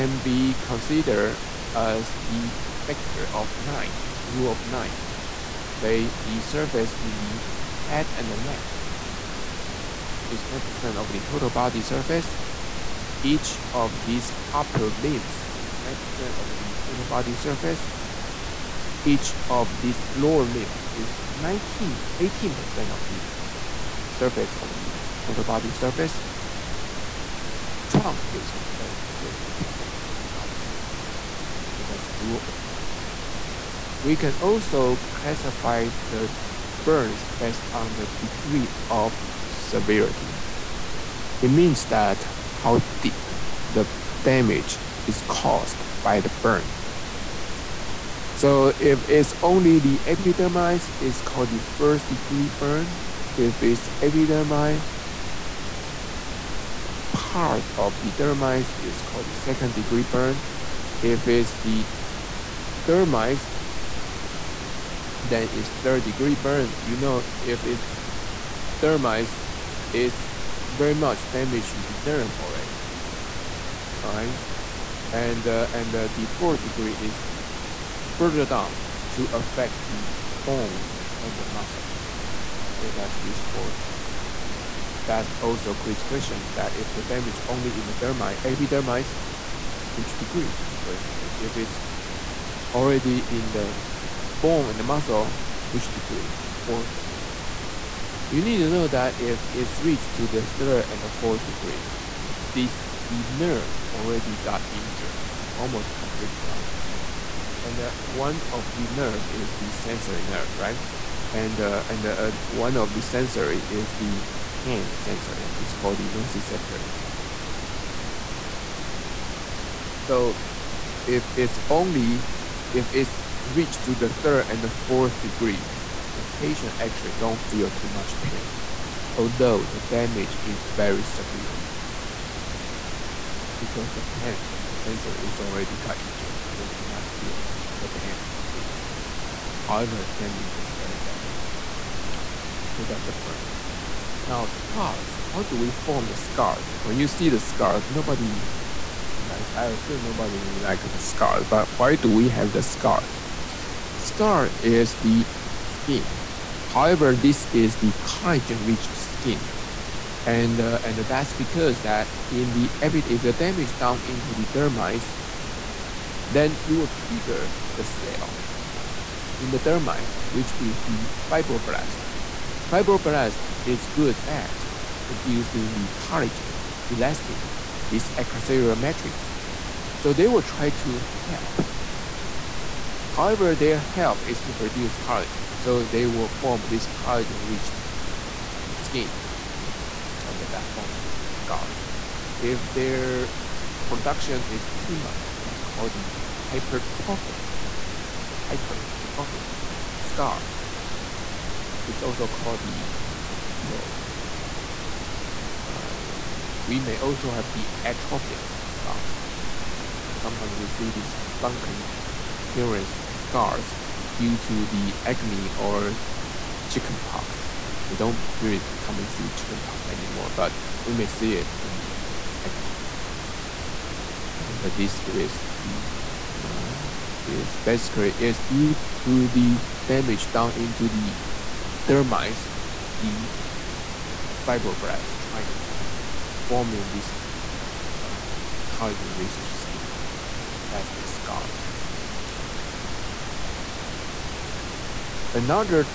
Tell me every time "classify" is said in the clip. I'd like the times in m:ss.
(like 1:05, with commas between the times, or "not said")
0:35.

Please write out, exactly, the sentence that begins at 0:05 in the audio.
Say the surface in the head and the neck is 9% of the total body surface.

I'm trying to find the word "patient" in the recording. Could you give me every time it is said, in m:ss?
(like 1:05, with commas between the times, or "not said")
2:06.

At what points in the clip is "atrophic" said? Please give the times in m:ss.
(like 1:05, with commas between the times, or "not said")
3:27.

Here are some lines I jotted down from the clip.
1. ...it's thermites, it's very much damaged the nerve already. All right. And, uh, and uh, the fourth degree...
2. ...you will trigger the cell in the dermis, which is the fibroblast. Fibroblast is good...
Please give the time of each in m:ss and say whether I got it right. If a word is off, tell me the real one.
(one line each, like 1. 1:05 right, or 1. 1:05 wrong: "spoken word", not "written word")
1. 1:07 right
2. 2:46 right.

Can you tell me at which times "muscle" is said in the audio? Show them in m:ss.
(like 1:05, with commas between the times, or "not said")
1:21, 1:34.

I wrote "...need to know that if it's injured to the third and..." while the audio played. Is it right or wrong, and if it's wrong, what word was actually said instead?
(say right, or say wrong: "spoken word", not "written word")
wrong: "reached", not "injured".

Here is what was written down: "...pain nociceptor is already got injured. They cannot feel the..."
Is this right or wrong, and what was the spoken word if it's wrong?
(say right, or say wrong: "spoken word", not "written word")
wrong: "sensor", not "nociceptor".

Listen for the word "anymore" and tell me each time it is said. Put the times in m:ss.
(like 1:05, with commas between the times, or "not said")
2:18, 3:39.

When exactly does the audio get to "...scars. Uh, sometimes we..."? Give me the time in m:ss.
3:28.